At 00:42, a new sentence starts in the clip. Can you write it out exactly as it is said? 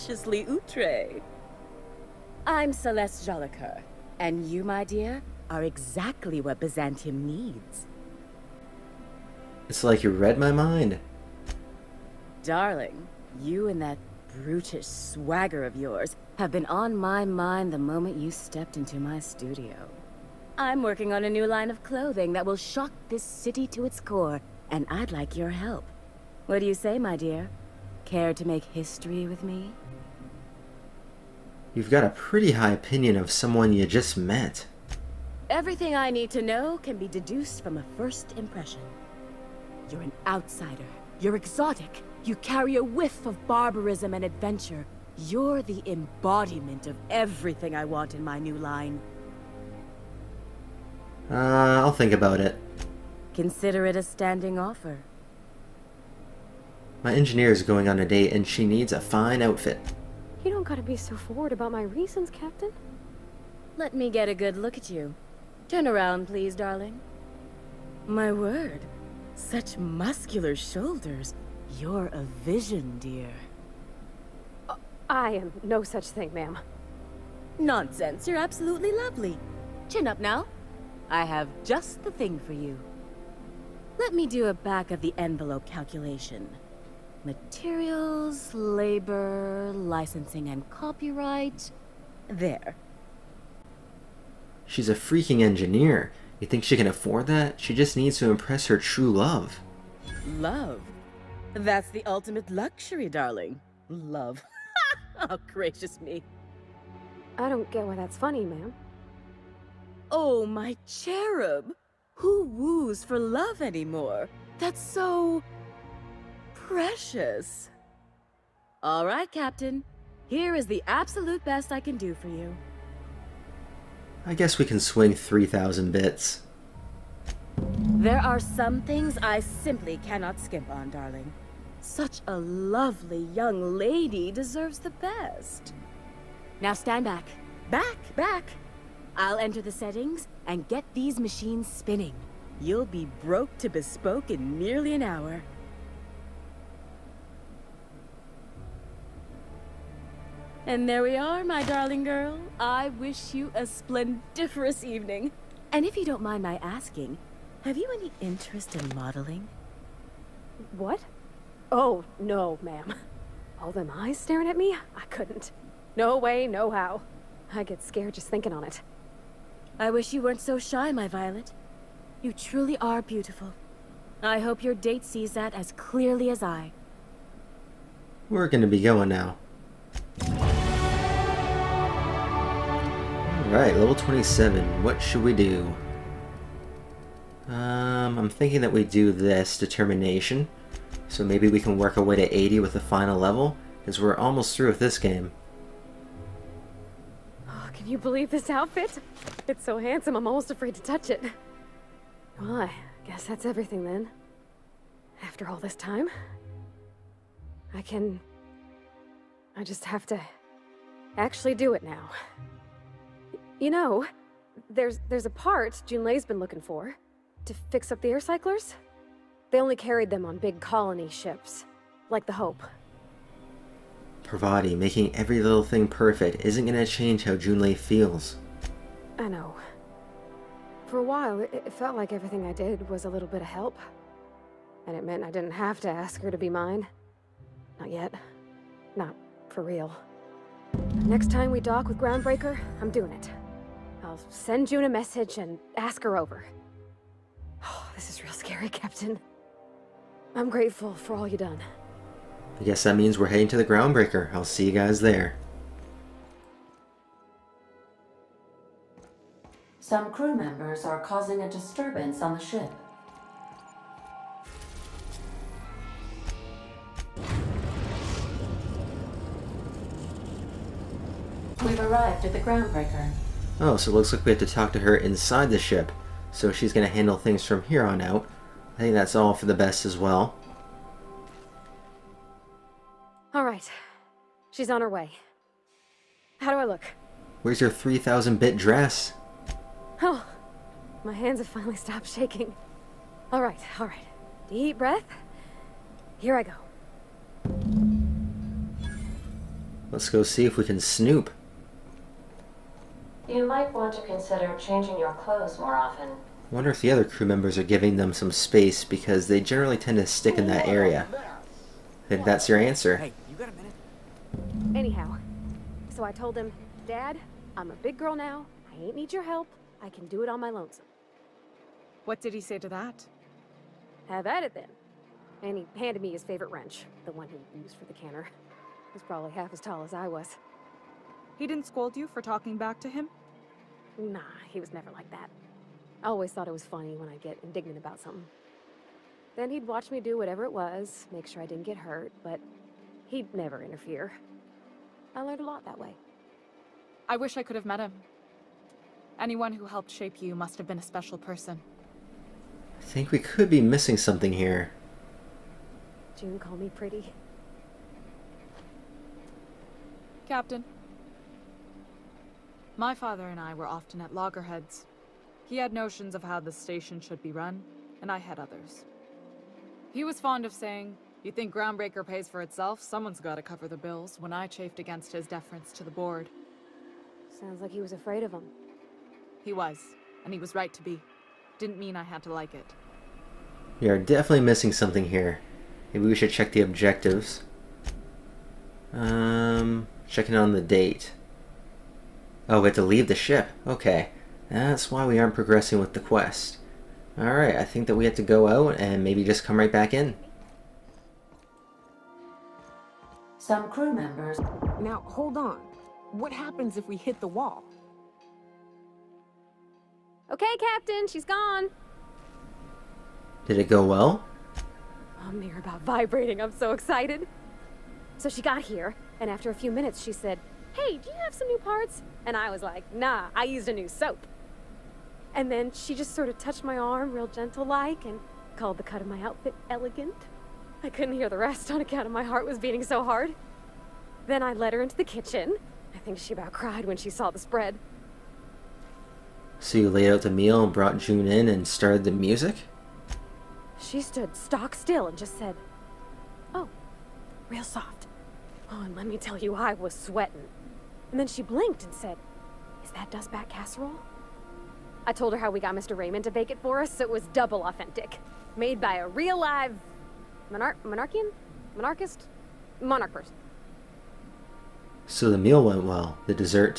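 You carry a whiff of barbarism and adventure.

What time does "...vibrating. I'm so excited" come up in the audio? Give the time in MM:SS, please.
06:55.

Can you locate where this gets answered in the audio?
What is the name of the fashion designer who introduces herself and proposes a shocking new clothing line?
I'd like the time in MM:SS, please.
00:02.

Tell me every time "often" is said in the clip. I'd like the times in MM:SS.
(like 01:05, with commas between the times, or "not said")
05:05, 06:03.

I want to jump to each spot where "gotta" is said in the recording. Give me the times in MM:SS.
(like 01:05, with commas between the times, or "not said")
01:00, 06:13.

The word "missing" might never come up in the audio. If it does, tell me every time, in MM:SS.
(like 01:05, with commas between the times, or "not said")
05:53, 06:24.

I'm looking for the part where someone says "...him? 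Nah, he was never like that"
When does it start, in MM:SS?
05:32.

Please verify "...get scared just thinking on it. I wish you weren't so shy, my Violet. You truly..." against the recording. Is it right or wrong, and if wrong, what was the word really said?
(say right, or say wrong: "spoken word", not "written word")
right.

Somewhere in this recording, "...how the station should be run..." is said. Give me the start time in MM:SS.
06:06.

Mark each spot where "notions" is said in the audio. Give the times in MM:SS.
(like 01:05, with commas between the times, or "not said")
06:05.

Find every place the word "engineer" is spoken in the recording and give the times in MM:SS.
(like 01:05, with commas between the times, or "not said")
00:57, 01:35.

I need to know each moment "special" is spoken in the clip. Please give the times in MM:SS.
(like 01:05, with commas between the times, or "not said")
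05:50.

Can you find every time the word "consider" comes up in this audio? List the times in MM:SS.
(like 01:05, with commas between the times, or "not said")
00:53, 05:04.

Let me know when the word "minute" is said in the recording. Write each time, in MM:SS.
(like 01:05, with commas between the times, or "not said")
05:13, 06:59.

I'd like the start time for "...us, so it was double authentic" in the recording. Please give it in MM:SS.
07:36.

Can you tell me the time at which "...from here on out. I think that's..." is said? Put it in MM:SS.
04:37.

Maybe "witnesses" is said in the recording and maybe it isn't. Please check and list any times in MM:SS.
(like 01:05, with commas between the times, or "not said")
not said.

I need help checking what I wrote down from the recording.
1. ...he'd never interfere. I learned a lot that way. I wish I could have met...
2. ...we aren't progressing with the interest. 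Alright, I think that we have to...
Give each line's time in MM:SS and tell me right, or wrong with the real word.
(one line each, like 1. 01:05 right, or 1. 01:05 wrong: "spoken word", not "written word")
1. 05:43 right
2. 06:35 wrong: "quest", not "interest".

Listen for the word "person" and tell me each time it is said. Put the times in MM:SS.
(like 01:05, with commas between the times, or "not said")
05:51, 07:43.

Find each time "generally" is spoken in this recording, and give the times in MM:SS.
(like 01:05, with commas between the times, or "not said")
05:09.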